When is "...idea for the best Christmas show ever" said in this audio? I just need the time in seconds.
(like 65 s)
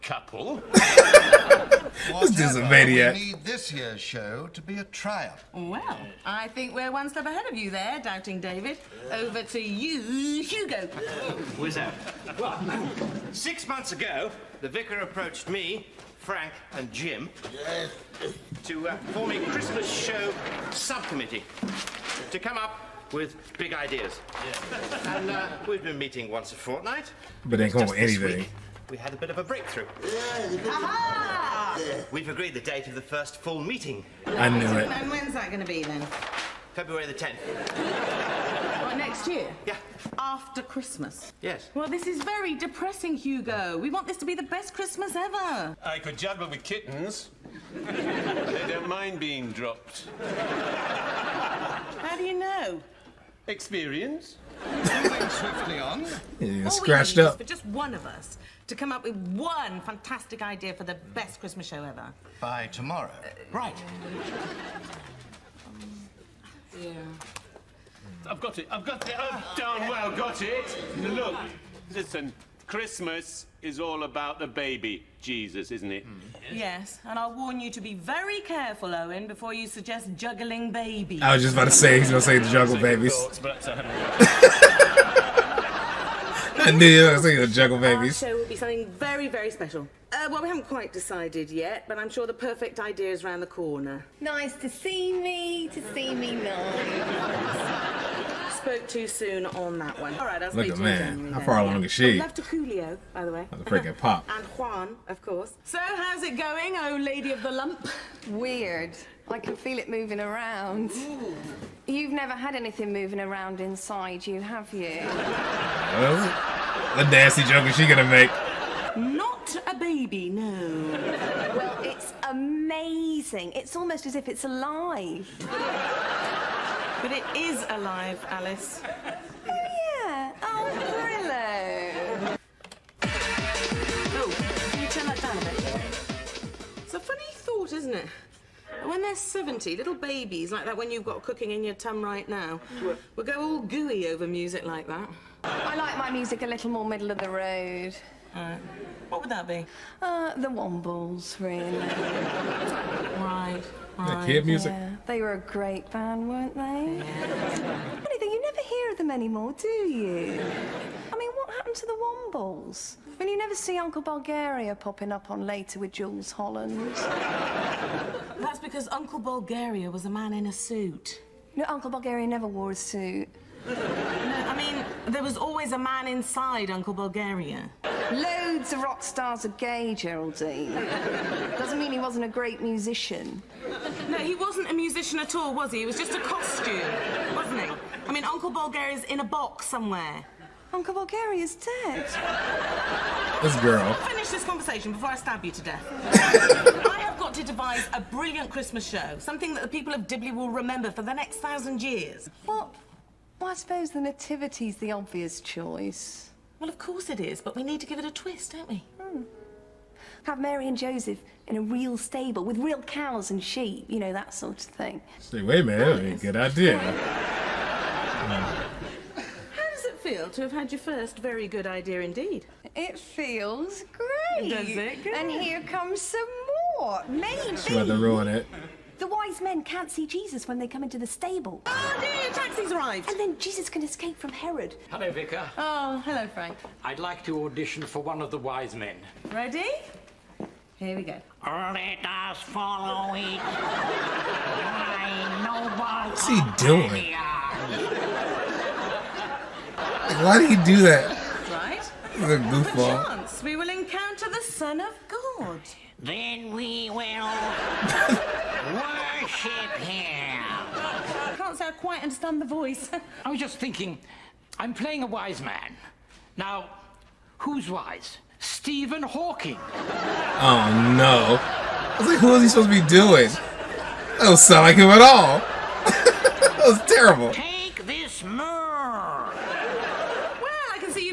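60 s.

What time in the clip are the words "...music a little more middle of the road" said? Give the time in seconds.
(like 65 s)
146 s.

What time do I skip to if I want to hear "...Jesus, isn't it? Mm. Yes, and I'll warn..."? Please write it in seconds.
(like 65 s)
75 s.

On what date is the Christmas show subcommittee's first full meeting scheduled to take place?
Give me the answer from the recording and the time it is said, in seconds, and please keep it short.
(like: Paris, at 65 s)
February 10th, at 36 s.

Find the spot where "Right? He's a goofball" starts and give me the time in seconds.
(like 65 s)
251 s.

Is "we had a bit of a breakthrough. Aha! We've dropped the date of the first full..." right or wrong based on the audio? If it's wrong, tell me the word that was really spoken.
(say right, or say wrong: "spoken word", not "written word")
wrong: "agreed", not "dropped".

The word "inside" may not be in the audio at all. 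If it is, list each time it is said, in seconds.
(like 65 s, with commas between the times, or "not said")
113 s, 176 s.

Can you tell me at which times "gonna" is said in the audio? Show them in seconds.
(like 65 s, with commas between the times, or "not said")
82 s, 87 s, 117 s.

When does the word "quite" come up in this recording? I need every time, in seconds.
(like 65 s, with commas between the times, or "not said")
90 s, 261 s.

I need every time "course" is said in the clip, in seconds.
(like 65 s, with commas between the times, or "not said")
105 s, 206 s.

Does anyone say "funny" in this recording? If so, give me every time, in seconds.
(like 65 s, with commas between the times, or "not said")
136 s, 158 s.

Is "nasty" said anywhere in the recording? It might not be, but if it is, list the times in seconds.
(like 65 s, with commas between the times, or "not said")
117 s.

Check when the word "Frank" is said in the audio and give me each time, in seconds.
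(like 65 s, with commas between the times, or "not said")
16 s, 236 s.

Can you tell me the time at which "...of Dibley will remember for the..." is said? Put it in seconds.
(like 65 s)
199 s.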